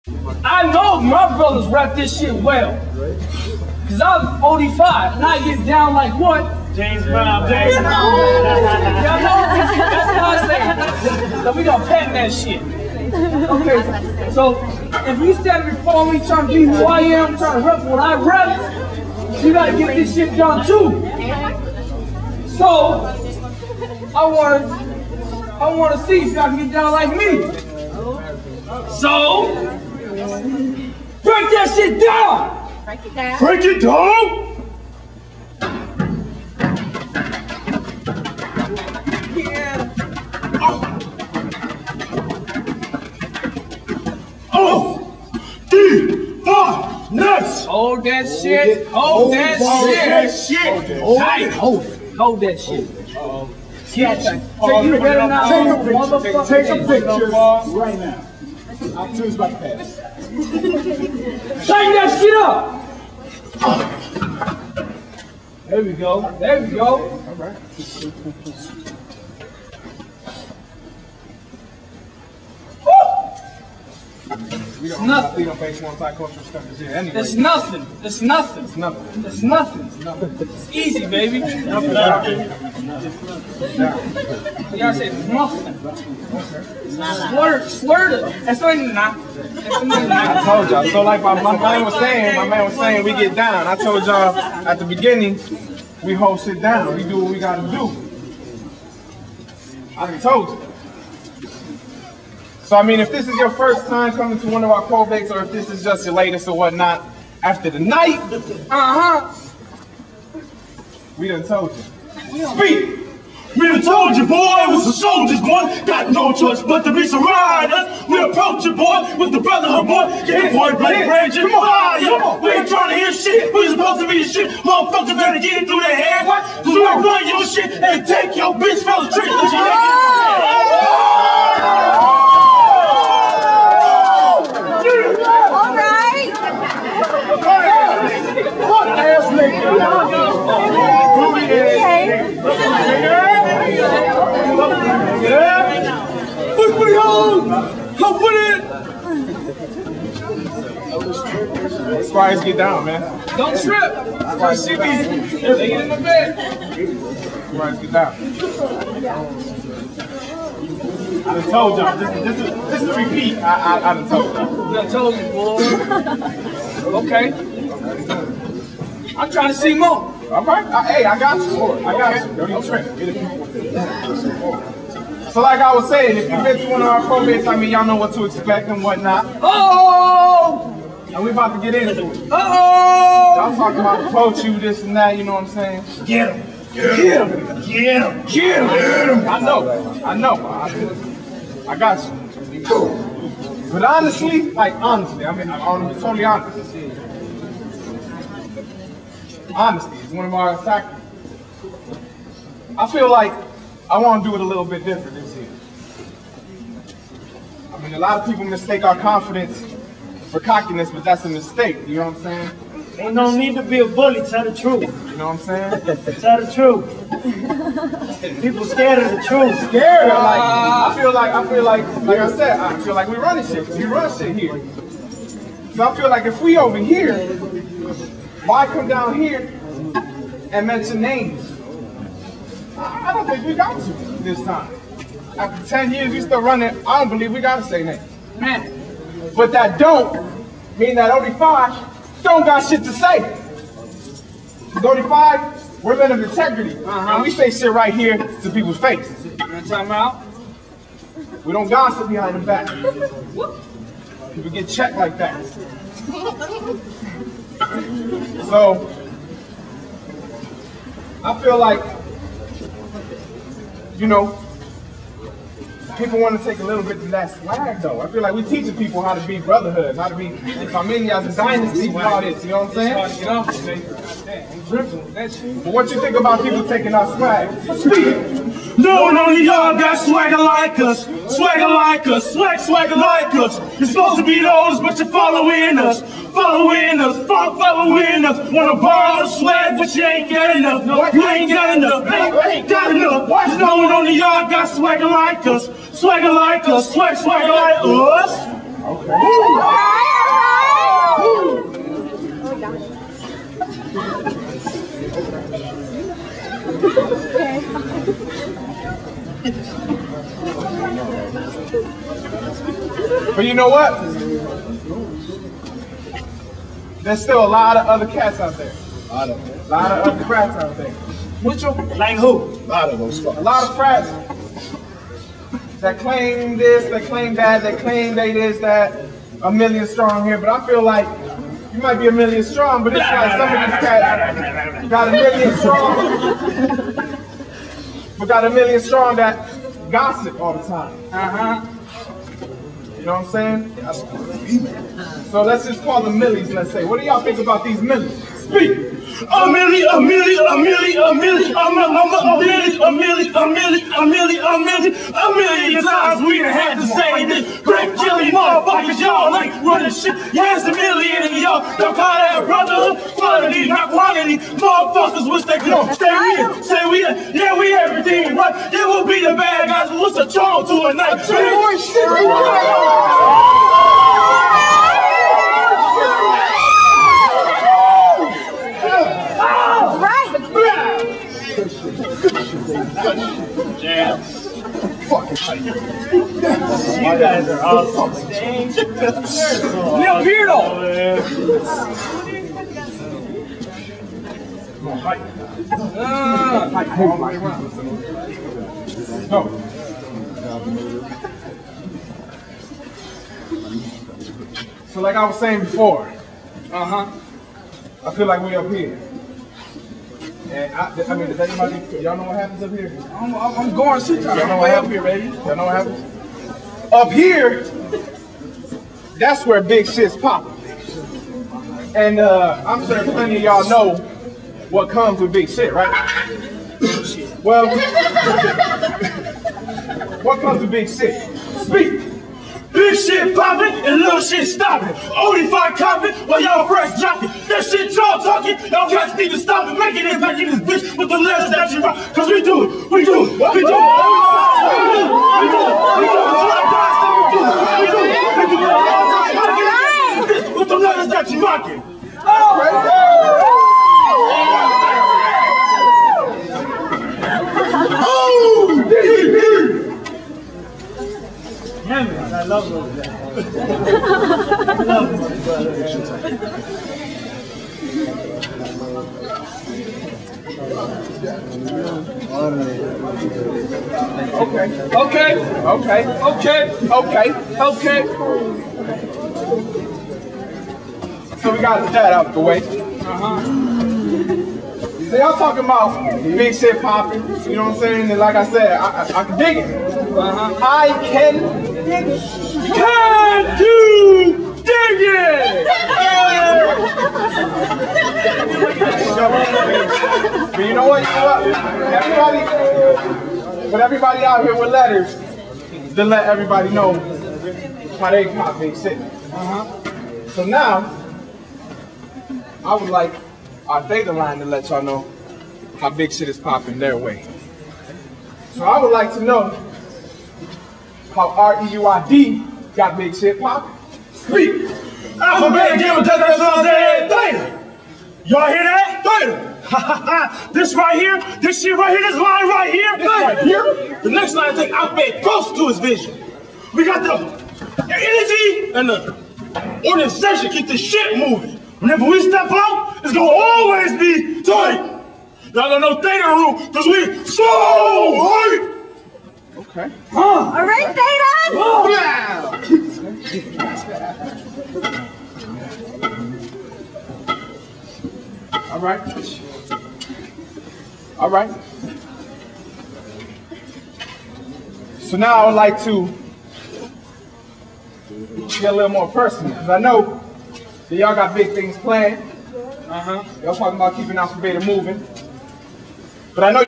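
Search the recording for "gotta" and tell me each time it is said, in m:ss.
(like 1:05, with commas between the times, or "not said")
0:19, 1:21, 1:37, 3:57.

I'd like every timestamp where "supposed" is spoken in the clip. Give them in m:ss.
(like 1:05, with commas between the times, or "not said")
2:03, 4:43.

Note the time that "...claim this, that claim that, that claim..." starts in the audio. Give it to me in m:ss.
5:25.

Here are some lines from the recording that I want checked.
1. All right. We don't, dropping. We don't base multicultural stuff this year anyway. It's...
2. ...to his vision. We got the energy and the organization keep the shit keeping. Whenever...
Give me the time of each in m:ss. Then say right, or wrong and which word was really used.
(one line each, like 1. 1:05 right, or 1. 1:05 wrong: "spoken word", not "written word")
1. 1:07 wrong: "nothing", not "dropping"
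2. 8:55 wrong: "moving", not "keeping".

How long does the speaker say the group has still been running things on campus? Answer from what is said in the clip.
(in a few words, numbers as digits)
10 years.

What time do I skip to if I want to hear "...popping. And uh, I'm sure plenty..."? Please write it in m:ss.
7:00.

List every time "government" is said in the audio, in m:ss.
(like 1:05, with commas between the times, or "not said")
not said.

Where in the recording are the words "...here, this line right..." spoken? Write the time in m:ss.
8:51.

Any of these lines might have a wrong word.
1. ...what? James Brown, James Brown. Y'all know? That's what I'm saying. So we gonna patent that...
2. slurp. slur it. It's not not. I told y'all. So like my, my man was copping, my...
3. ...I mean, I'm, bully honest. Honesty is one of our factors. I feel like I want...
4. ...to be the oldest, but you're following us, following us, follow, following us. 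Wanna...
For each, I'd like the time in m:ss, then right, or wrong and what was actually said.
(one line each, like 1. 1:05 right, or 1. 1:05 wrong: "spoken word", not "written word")
1. 0:06 right
2. 1:27 wrong: "saying", not "copping"
3. 3:15 wrong: "totally", not "bully"
4. 4:44 right.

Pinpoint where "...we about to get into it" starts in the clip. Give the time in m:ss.
3:01.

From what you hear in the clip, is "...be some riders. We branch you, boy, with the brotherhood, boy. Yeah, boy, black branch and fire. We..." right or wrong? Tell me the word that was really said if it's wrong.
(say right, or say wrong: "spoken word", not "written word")
wrong: "approach", not "branch".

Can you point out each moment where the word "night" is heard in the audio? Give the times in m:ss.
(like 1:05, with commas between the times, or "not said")
1:47, 6:10.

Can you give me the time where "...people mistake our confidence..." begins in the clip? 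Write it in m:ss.
3:28.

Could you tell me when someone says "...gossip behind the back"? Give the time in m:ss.
4:11.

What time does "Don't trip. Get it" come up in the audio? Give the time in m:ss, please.
2:52.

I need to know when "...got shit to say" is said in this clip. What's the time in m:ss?
4:02.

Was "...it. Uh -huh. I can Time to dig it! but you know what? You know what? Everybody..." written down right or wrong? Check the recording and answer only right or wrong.
right.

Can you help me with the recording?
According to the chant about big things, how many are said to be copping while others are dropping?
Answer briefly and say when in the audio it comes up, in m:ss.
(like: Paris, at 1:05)
5, at 7:15.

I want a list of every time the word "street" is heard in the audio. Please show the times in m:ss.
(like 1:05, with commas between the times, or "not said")
2:09.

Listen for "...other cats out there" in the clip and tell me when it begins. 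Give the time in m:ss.
5:17.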